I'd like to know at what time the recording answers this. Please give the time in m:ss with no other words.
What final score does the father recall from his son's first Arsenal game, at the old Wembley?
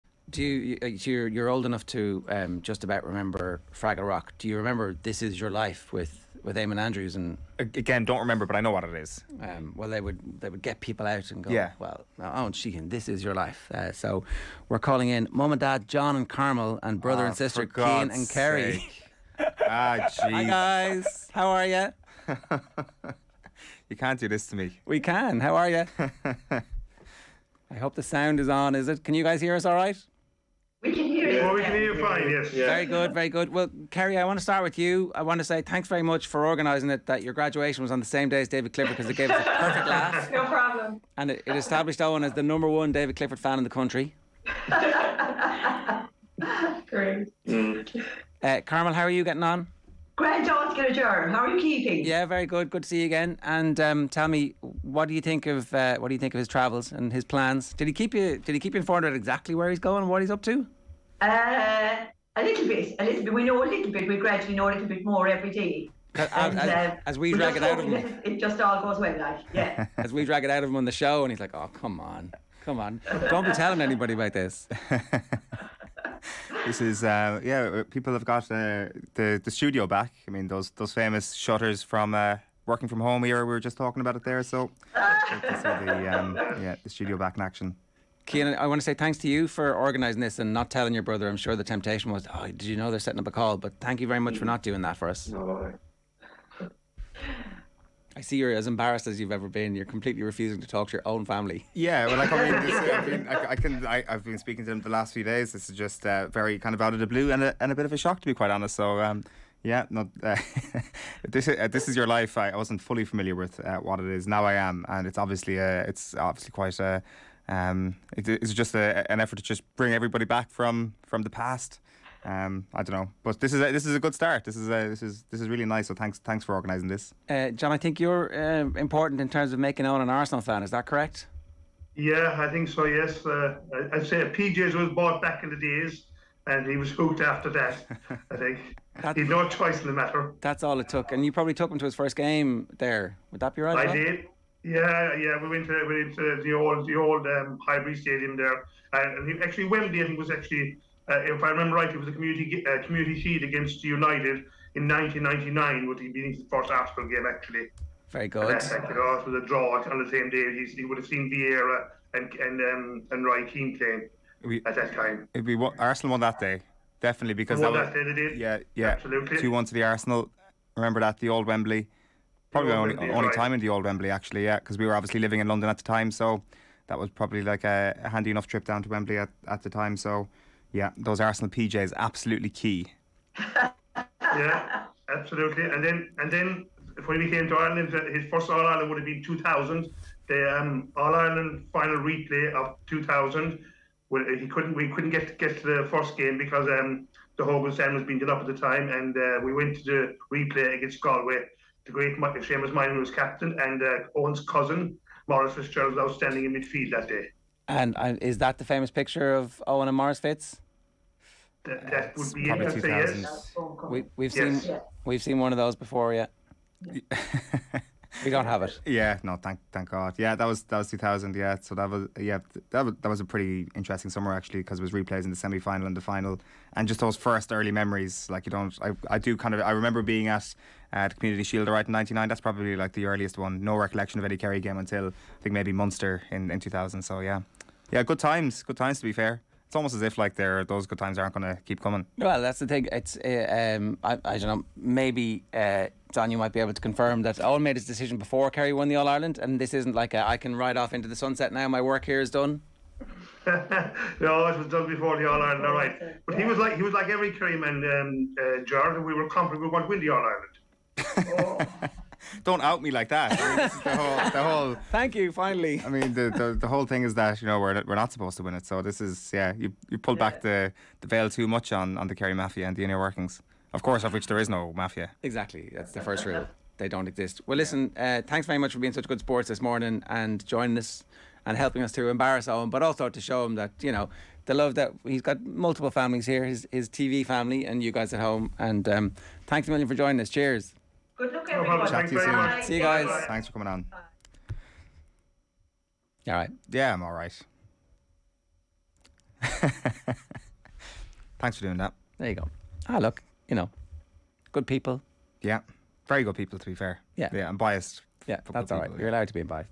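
2:49.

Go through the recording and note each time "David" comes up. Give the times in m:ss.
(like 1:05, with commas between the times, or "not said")
0:38, 0:42.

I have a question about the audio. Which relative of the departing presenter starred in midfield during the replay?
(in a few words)
Maurice Fitzgerald.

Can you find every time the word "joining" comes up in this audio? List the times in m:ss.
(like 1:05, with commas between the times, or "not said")
4:40, 4:49.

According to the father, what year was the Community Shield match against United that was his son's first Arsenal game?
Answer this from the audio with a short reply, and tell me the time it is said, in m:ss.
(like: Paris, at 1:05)
1999, at 2:34.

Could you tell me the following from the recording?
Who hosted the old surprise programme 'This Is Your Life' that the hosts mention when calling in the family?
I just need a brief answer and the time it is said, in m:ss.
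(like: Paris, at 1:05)
Eamon Andrews, at 0:06.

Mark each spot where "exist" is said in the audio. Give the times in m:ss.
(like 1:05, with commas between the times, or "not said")
4:37.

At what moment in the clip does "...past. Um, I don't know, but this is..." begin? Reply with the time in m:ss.
2:01.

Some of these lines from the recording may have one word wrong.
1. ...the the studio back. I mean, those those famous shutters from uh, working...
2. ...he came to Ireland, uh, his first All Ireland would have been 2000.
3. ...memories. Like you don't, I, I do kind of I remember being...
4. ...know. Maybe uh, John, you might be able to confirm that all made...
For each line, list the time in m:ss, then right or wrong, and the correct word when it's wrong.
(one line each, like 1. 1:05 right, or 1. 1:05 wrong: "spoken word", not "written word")
1. 1:19 right
2. 3:07 right
3. 3:47 right
4. 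4:04 right.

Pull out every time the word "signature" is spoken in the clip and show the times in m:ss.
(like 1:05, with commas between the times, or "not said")
not said.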